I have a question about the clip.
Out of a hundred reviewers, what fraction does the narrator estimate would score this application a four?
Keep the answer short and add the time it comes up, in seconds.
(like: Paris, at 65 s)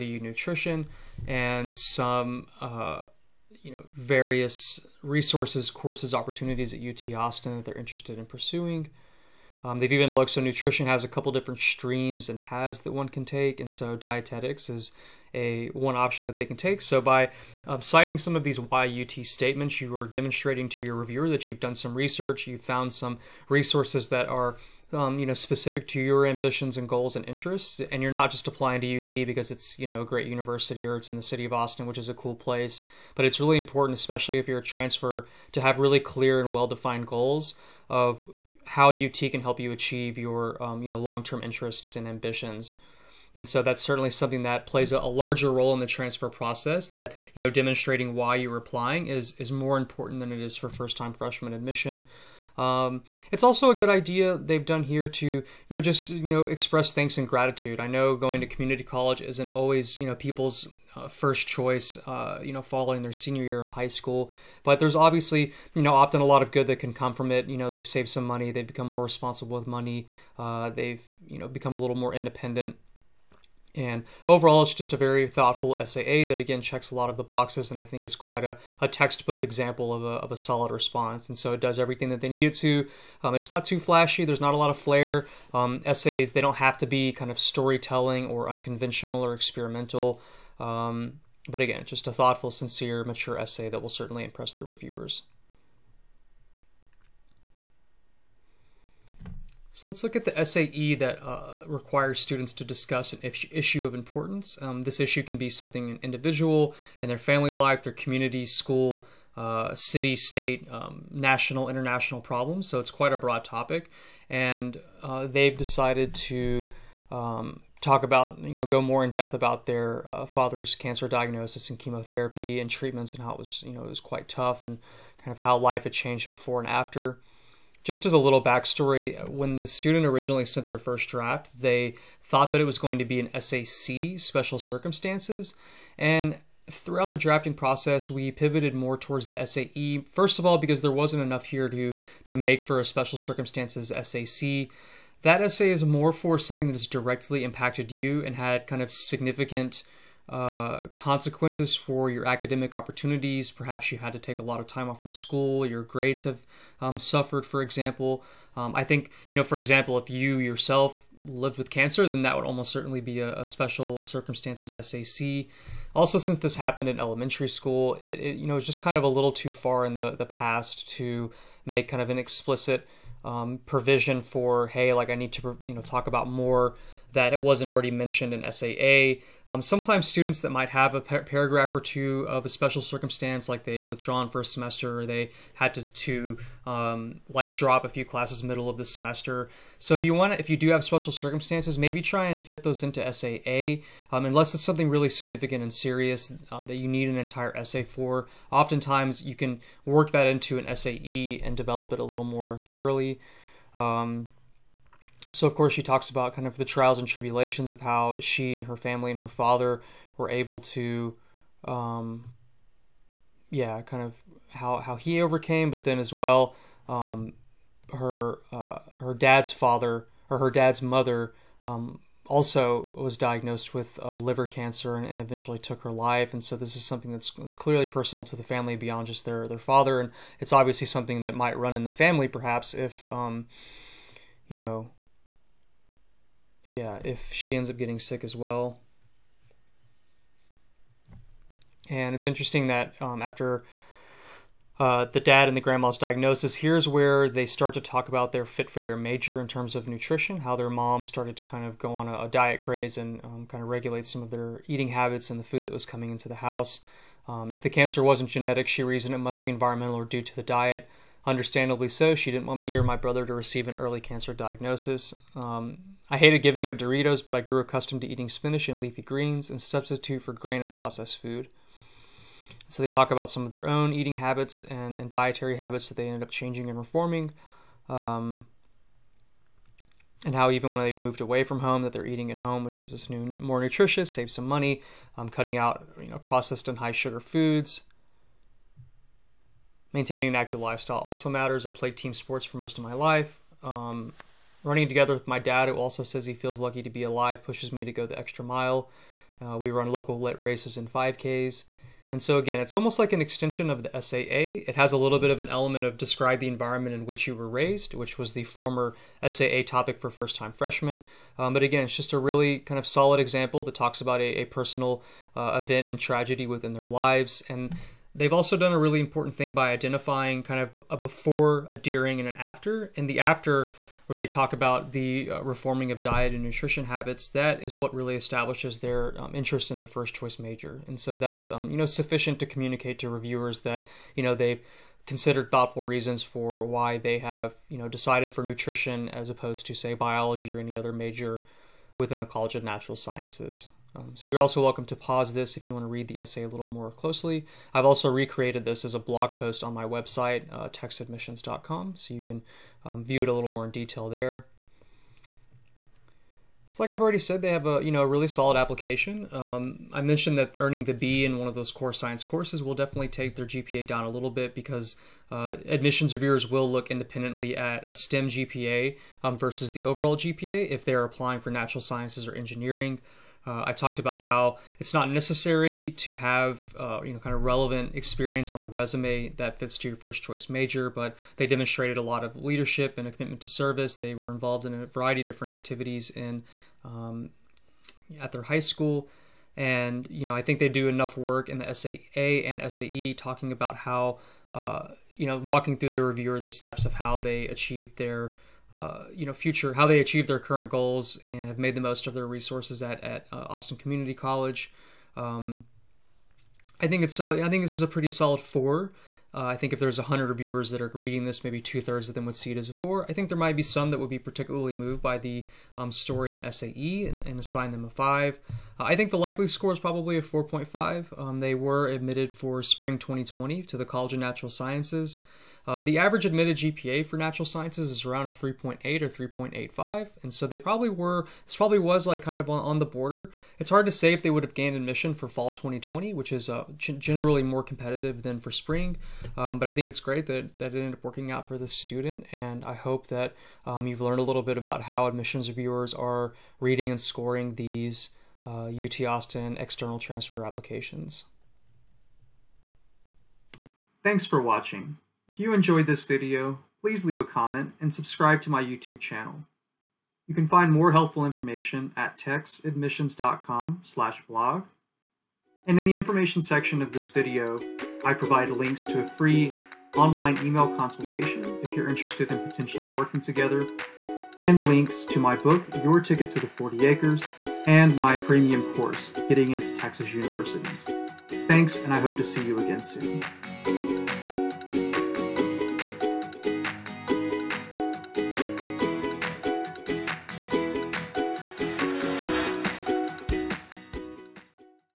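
two thirds, at 411 s.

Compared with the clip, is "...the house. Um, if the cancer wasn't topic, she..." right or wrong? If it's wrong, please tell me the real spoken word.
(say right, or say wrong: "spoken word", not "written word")
wrong: "genetic", not "topic".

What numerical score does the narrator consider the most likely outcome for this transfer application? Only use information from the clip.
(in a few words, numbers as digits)
4.5.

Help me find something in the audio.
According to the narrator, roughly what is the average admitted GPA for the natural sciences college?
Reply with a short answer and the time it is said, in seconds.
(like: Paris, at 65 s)
3.8 or 3.85, at 428 s.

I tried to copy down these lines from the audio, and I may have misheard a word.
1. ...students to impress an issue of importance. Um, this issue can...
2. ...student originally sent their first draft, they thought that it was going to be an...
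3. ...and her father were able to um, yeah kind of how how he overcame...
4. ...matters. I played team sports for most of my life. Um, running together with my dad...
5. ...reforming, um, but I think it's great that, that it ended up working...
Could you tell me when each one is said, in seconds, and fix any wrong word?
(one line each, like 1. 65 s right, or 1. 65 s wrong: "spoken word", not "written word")
1. 102 s wrong: "discuss", not "impress"
2. 129 s right
3. 209 s right
4. 291 s right
5. 438 s wrong: "spring", not "reforming".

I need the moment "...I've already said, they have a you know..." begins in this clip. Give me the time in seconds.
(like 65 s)
356 s.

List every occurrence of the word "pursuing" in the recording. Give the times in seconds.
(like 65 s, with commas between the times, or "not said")
8 s.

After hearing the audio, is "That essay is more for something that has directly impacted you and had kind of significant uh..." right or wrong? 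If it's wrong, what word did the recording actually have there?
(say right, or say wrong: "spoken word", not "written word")
right.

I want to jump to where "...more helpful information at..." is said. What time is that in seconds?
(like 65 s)
460 s.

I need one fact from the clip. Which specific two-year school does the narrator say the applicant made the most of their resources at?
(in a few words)
Austin Community College.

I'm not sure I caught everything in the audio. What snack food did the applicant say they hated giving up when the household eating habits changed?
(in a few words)
Doritos.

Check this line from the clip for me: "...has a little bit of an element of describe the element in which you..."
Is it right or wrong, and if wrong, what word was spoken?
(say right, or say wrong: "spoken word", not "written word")
wrong: "environment", not "element".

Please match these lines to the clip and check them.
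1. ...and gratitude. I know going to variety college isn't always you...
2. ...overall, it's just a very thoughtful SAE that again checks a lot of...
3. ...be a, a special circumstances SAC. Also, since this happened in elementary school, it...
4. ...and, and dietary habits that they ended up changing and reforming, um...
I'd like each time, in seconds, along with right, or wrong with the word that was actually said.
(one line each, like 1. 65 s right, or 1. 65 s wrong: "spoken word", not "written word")
1. 57 s wrong: "community", not "variety"
2. 74 s wrong: "SAA", not "SAE"
3. 162 s right
4. 274 s right.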